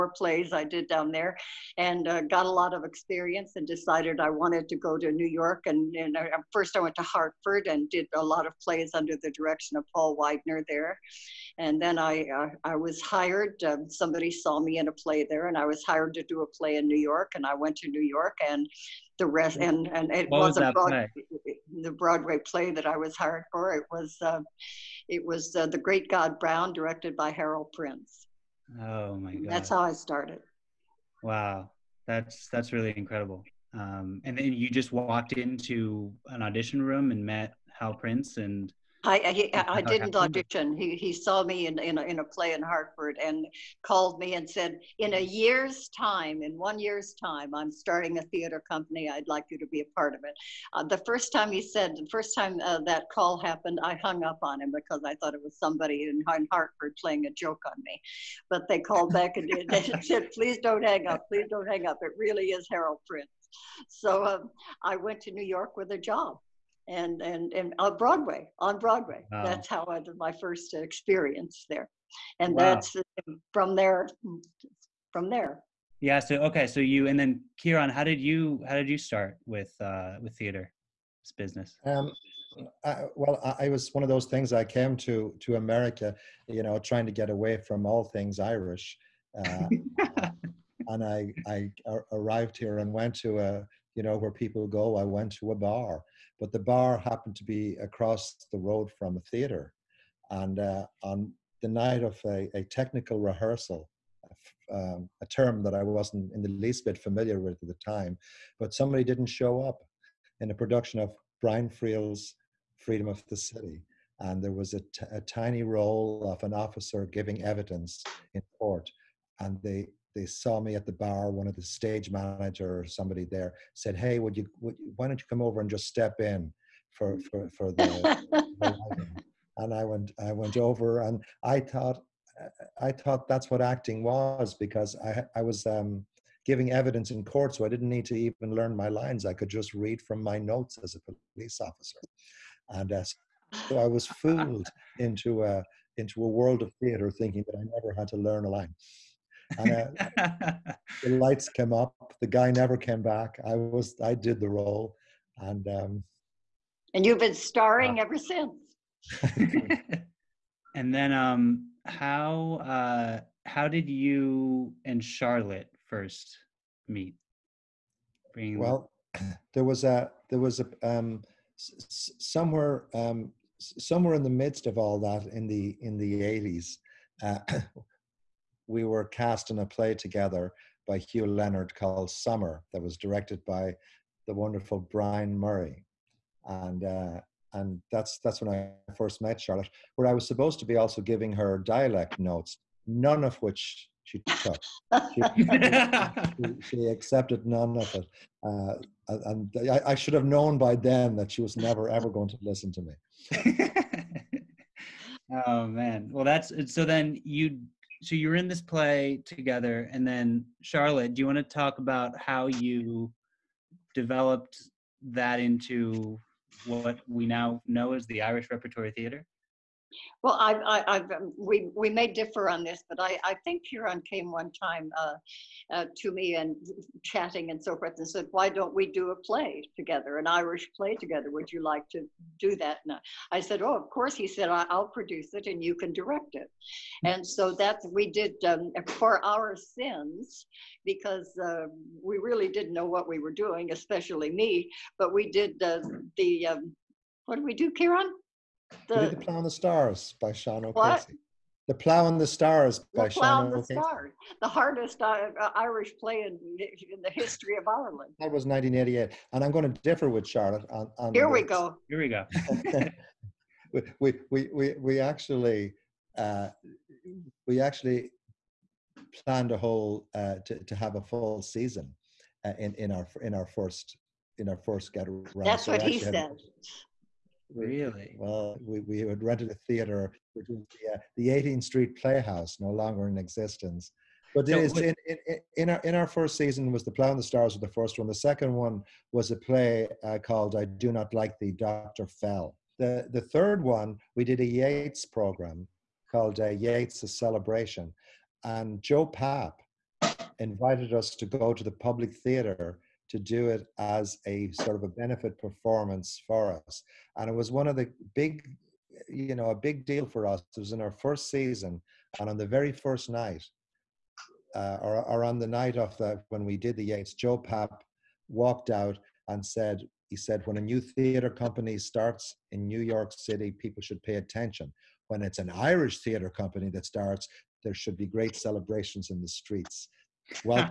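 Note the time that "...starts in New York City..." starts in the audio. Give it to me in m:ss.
5:21.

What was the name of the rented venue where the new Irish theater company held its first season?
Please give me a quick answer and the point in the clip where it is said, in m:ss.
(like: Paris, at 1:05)
18th Street Playhouse, at 4:41.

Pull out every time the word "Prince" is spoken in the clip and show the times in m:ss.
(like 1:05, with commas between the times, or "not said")
0:27, 0:37, 1:03.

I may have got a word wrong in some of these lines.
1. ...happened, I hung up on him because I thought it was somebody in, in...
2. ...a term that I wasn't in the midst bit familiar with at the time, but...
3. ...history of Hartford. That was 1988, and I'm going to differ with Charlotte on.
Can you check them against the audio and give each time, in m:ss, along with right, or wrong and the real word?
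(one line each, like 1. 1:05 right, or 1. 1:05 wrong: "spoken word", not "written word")
1. 0:53 right
2. 1:45 wrong: "least", not "midst"
3. 4:17 wrong: "Ireland", not "Hartford".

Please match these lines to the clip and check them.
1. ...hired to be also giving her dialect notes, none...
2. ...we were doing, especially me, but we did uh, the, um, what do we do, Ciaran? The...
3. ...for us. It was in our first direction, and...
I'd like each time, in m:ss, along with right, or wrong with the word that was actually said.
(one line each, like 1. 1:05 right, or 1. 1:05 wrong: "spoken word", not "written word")
1. 3:10 wrong: "supposed", not "hired"
2. 4:03 right
3. 5:10 wrong: "season", not "direction".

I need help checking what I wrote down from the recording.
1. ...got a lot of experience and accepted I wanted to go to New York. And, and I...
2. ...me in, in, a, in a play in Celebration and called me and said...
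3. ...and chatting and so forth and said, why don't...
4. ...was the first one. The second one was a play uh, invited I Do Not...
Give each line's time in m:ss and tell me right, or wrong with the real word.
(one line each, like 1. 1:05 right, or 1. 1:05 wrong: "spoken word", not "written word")
1. 0:02 wrong: "decided", not "accepted"
2. 0:41 wrong: "Hartford", not "Celebration"
3. 3:46 right
4. 4:47 wrong: "called", not "invited".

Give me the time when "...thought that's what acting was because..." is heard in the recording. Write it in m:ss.
2:12.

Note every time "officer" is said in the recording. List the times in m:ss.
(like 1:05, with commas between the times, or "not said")
1:56, 2:21.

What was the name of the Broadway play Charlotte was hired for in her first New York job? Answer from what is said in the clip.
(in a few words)
The Great God Brown.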